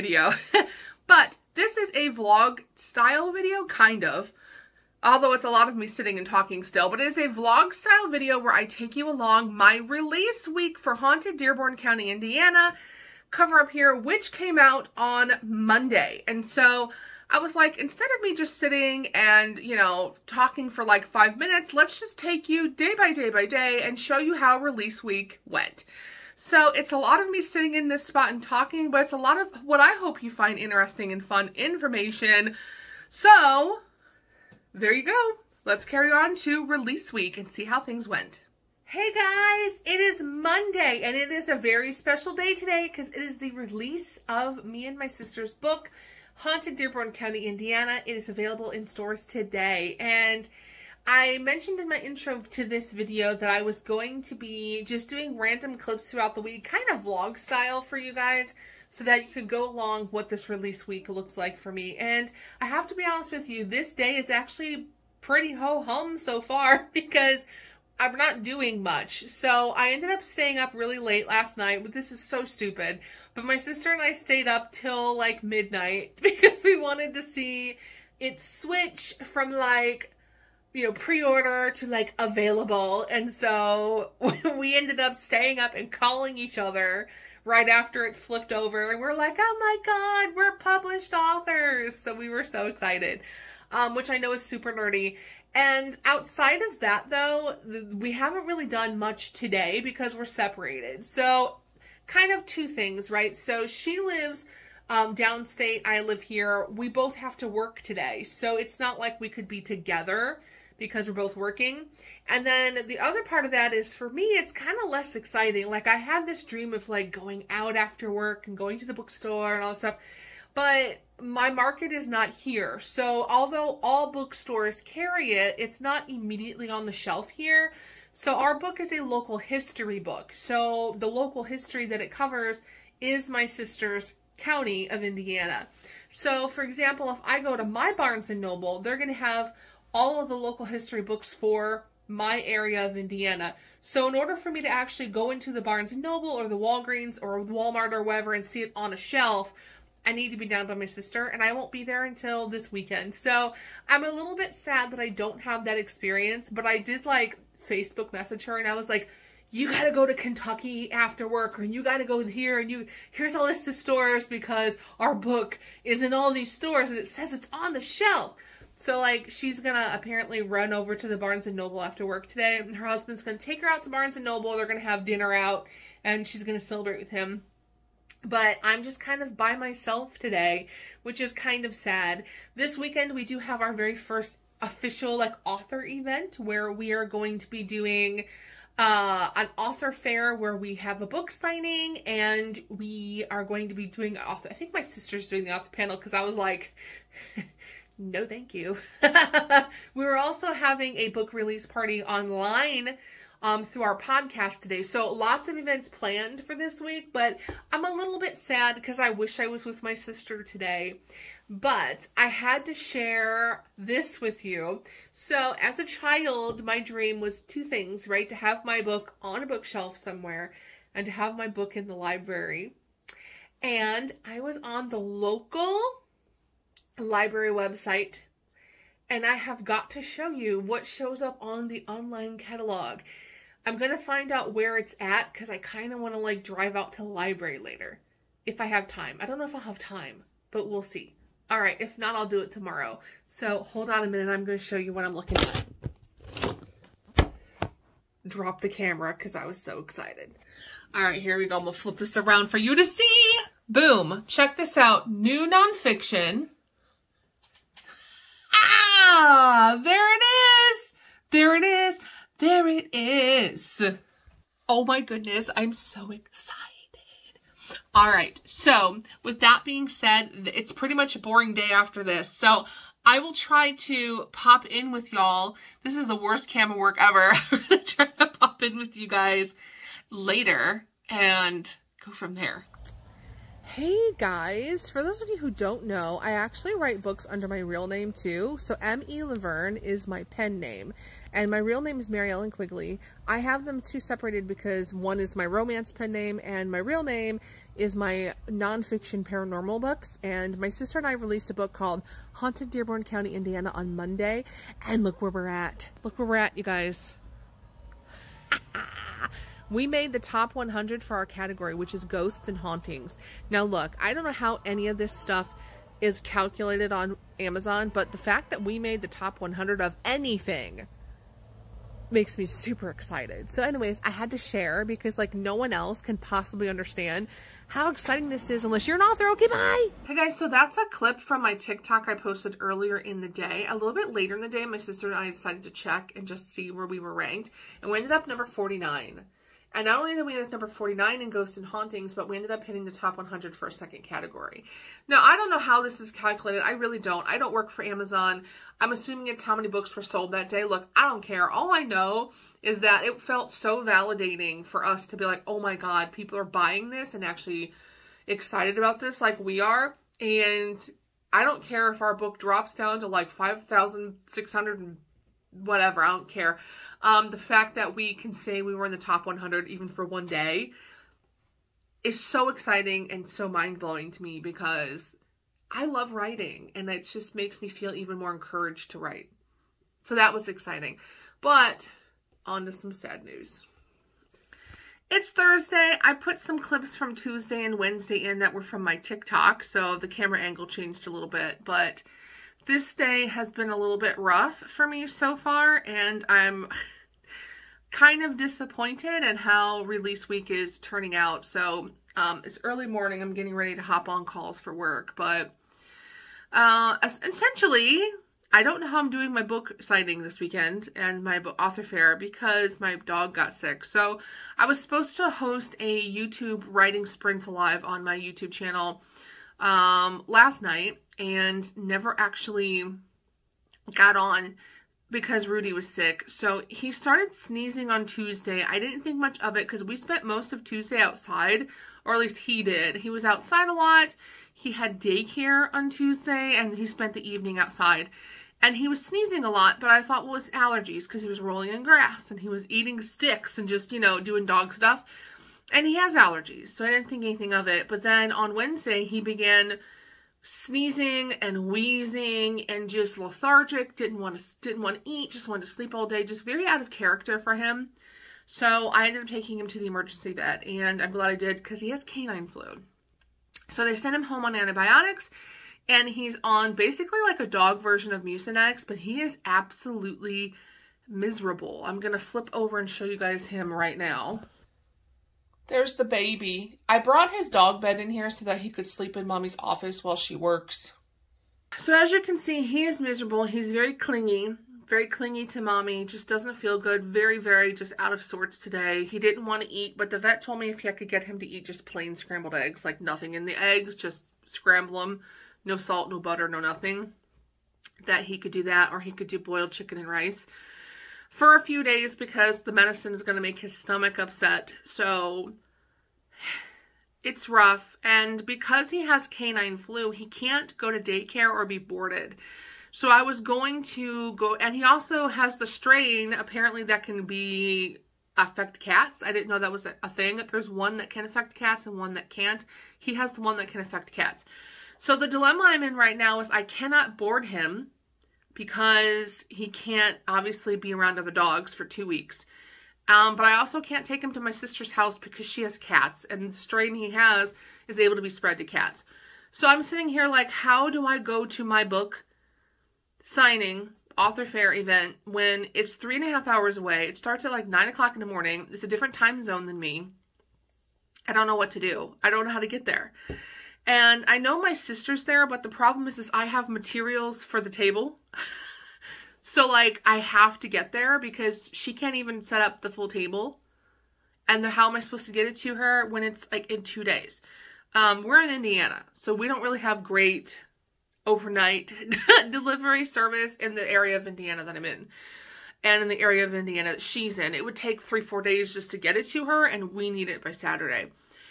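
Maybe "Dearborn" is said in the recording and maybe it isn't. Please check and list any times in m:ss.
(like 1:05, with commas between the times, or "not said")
0:11, 0:46, 5:02.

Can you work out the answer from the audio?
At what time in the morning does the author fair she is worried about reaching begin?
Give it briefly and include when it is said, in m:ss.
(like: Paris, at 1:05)
9 o'clock, at 9:07.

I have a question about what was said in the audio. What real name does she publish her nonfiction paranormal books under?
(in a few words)
Mary Ellen Quigley.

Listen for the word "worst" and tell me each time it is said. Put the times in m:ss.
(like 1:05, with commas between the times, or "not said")
4:36.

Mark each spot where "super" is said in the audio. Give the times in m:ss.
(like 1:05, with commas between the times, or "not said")
1:34, 5:22.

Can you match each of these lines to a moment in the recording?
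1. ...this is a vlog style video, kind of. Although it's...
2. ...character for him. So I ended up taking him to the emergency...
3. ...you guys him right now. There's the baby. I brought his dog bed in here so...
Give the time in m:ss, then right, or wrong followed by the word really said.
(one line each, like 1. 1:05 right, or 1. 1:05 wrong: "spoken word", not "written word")
1. 0:01 right
2. 7:36 right
3. 7:53 right.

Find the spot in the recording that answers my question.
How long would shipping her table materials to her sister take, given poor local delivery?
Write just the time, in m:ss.
9:38.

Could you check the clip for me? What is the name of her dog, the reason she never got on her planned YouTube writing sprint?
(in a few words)
Rudy.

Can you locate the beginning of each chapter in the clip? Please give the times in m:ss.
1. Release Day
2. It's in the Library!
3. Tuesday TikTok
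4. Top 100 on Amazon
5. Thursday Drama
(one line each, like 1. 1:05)
1. 0:38
2. 3:33
3. 4:42
4. 5:30
5. 6:23.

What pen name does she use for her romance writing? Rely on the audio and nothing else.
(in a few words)
M.E. Laverne.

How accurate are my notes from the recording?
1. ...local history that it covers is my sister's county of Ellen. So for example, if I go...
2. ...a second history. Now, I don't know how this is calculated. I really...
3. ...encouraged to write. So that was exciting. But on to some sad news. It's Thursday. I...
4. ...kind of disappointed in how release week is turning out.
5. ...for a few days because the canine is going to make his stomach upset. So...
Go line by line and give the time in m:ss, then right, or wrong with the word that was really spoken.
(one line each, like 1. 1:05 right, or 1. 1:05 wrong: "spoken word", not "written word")
1. 2:11 wrong: "Indiana", not "Ellen"
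2. 5:43 wrong: "category", not "history"
3. 6:18 right
4. 6:37 right
5. 8:21 wrong: "medicine", not "canine".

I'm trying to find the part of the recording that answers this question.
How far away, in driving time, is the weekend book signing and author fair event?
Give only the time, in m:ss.
9:05.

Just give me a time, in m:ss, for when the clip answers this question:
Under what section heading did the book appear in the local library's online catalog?
4:15.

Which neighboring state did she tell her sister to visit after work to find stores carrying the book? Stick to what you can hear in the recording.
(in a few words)
Kentucky.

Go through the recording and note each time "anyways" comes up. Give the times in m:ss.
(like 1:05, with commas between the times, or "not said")
5:23.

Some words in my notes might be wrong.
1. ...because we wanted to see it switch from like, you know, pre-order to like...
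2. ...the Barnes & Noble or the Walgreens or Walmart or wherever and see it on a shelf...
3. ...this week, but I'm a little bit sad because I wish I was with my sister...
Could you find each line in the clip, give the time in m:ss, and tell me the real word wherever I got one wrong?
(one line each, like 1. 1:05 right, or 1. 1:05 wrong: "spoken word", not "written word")
1. 1:16 right
2. 2:25 right
3. 3:26 right.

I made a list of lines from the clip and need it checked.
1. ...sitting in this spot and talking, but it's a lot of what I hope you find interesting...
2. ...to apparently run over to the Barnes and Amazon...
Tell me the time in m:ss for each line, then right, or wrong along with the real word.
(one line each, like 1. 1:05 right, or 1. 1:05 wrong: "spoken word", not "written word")
1. 0:27 right
2. 2:49 wrong: "Noble", not "Amazon".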